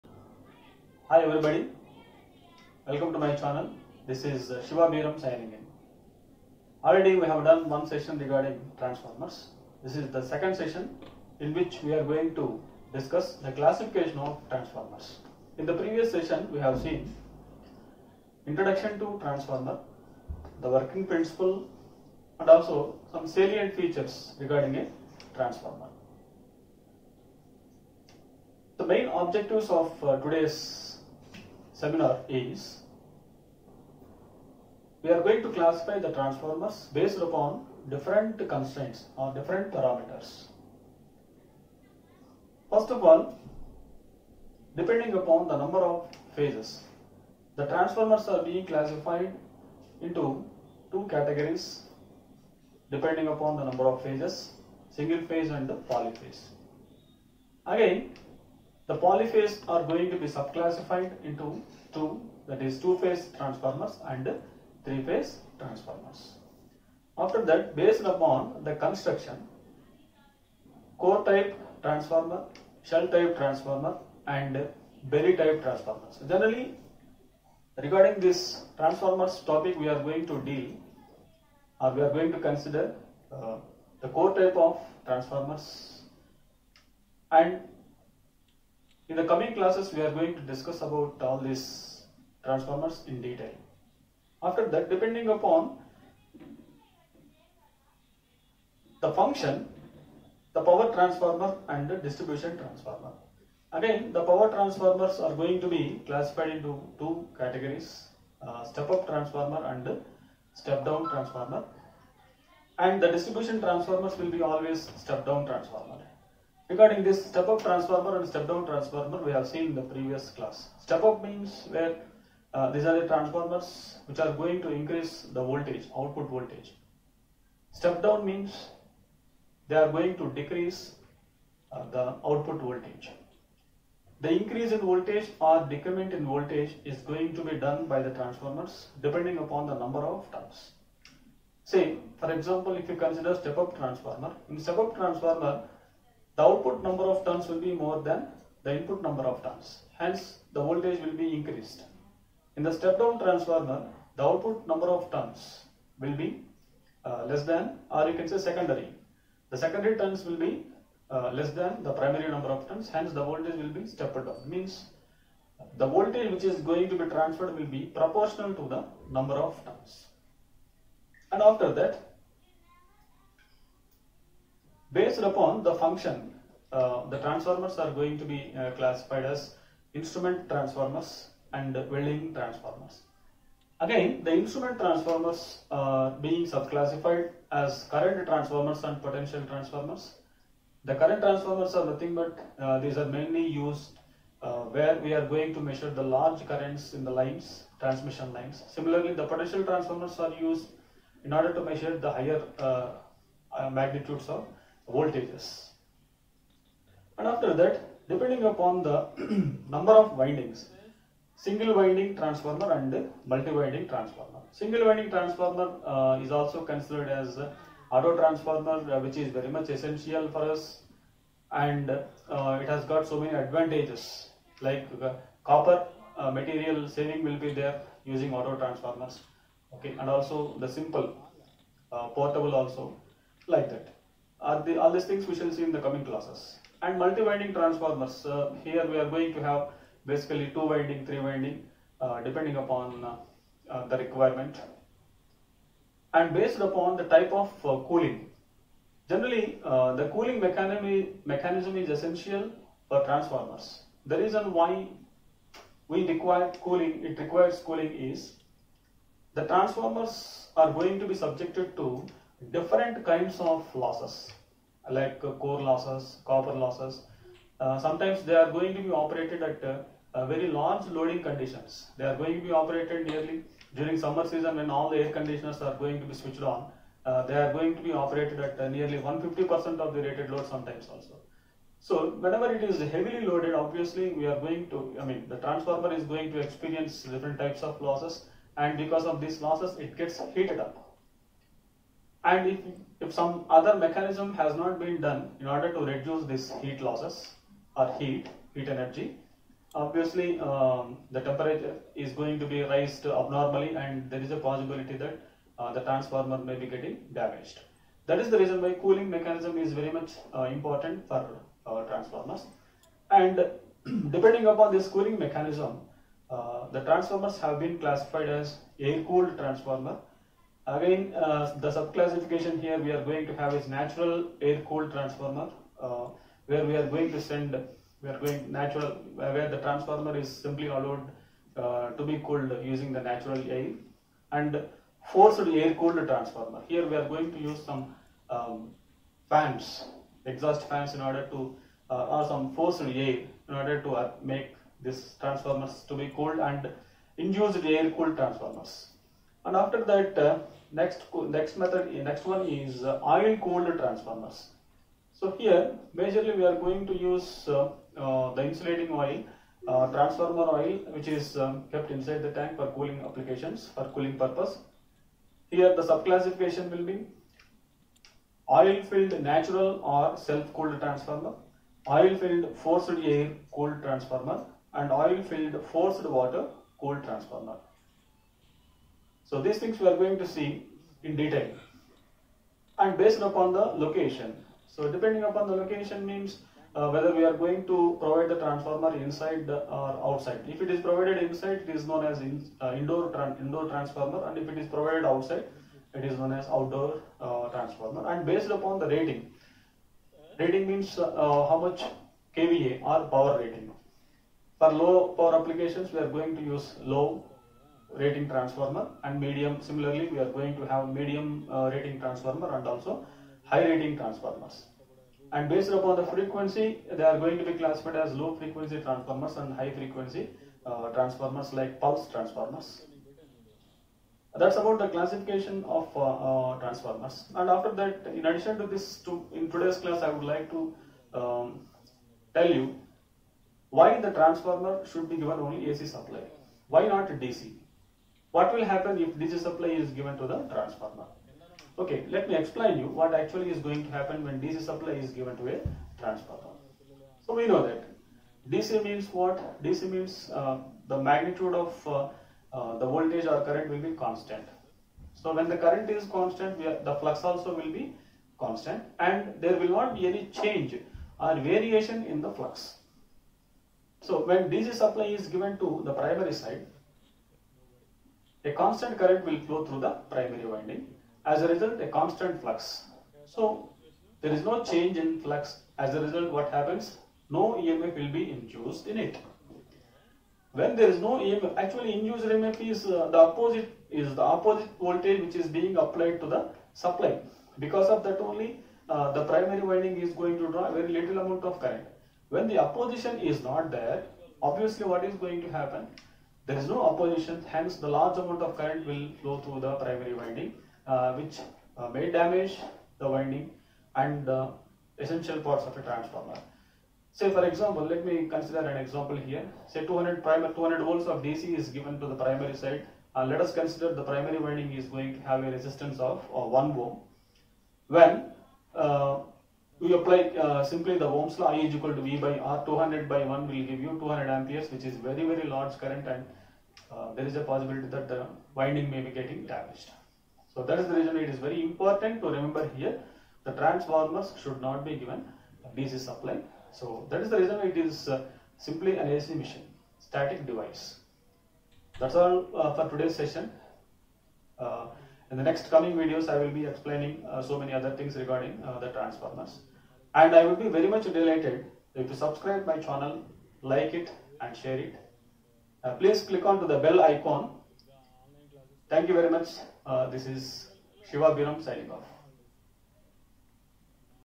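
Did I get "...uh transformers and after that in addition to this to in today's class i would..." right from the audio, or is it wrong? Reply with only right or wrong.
right.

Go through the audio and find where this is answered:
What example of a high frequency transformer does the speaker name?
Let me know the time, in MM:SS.
07:01.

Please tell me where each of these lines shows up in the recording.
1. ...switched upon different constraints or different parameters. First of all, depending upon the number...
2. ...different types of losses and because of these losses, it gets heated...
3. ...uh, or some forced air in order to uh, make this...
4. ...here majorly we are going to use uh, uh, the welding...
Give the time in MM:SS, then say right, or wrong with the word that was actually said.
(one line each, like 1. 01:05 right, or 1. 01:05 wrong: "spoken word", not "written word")
1. 00:36 wrong: "based", not "switched"
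2. 04:47 right
3. 05:41 right
4. 05:55 wrong: "insulating", not "welding".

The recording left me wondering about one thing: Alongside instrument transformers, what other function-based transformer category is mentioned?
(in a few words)
Welding transformers.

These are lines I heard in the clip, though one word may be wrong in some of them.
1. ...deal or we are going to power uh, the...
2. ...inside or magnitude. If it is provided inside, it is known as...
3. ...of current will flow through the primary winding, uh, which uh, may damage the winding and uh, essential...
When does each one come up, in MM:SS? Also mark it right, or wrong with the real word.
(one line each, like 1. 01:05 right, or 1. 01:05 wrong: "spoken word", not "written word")
1. 01:20 wrong: "consider", not "power"
2. 06:28 wrong: "outside", not "magnitude"
3. 08:18 right.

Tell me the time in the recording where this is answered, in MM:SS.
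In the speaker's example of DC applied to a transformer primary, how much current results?
08:43.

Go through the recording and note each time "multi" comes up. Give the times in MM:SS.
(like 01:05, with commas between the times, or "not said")
03:33, 03:56.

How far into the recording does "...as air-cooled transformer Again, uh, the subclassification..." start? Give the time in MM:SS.
05:18.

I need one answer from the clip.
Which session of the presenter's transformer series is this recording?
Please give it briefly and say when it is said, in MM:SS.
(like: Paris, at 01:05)
Second, at 00:10.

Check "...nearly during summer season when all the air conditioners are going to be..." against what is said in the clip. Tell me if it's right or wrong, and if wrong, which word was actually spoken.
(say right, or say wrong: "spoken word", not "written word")
right.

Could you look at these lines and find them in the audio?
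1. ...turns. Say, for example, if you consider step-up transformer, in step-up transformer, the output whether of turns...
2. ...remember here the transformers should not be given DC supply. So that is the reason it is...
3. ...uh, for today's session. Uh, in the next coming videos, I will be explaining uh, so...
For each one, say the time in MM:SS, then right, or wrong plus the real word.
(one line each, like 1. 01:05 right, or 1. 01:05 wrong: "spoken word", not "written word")
1. 02:20 wrong: "number", not "whether"
2. 08:52 right
3. 09:02 right.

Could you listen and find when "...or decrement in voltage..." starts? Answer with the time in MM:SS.
02:15.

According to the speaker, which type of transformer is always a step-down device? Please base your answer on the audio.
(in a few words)
Distribution transformer.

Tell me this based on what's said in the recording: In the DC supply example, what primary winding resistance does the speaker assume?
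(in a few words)
1 ohm.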